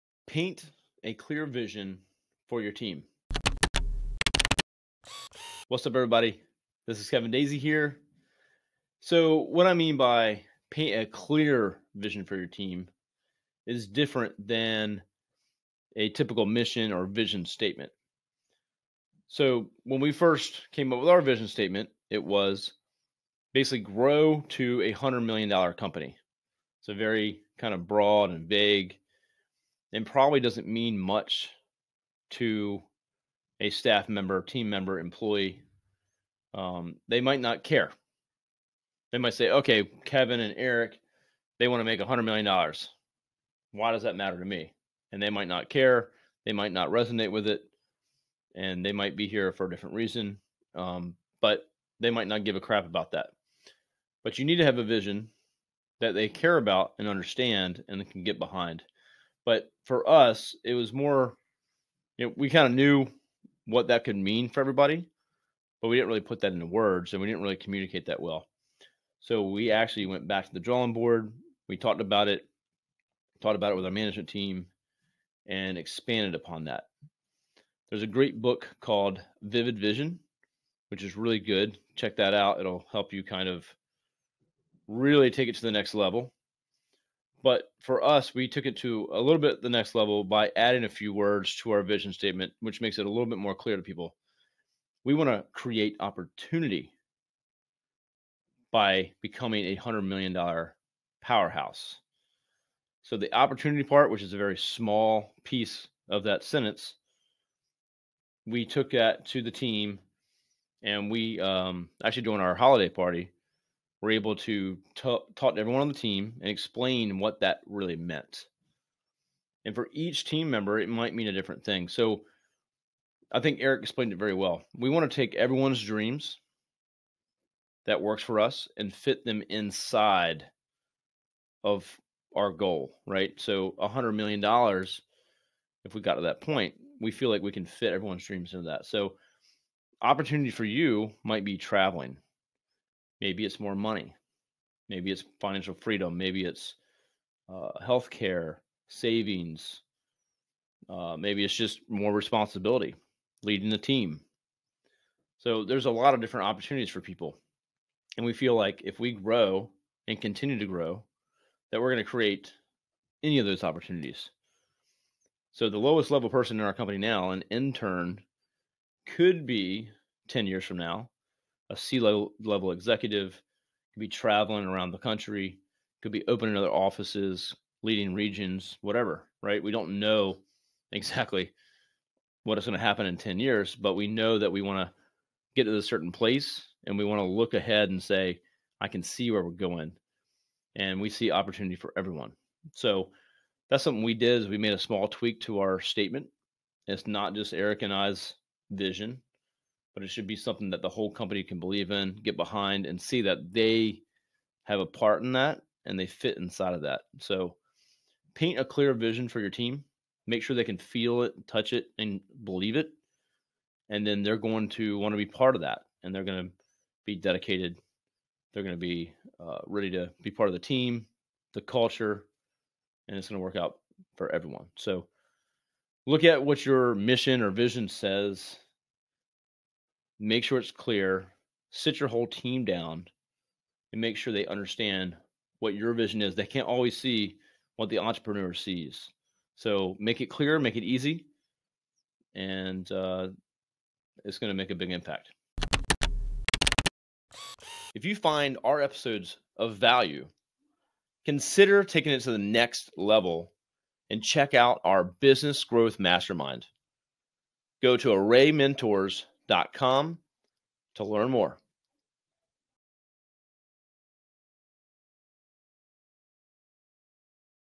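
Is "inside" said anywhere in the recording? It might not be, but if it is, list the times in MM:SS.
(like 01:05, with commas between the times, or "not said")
02:09, 03:26.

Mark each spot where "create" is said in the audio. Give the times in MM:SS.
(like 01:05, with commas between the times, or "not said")
01:35, 02:42.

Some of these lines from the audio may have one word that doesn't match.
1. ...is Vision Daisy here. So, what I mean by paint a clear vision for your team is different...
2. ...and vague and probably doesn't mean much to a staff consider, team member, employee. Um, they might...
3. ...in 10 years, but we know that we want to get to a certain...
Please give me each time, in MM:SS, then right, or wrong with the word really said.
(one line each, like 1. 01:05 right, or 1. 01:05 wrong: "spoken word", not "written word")
1. 00:07 wrong: "Kevin", not "Vision"
2. 00:28 wrong: "member", not "consider"
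3. 03:03 right.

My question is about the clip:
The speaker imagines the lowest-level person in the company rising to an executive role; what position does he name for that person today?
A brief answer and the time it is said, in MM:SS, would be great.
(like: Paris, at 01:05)
intern, at 02:47.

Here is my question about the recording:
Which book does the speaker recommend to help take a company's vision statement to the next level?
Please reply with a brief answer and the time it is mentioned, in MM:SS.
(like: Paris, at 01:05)
Vivid Vision, at 01:19.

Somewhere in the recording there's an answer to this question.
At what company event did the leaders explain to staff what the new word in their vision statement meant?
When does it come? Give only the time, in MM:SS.
01:52.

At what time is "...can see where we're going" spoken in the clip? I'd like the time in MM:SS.
03:08.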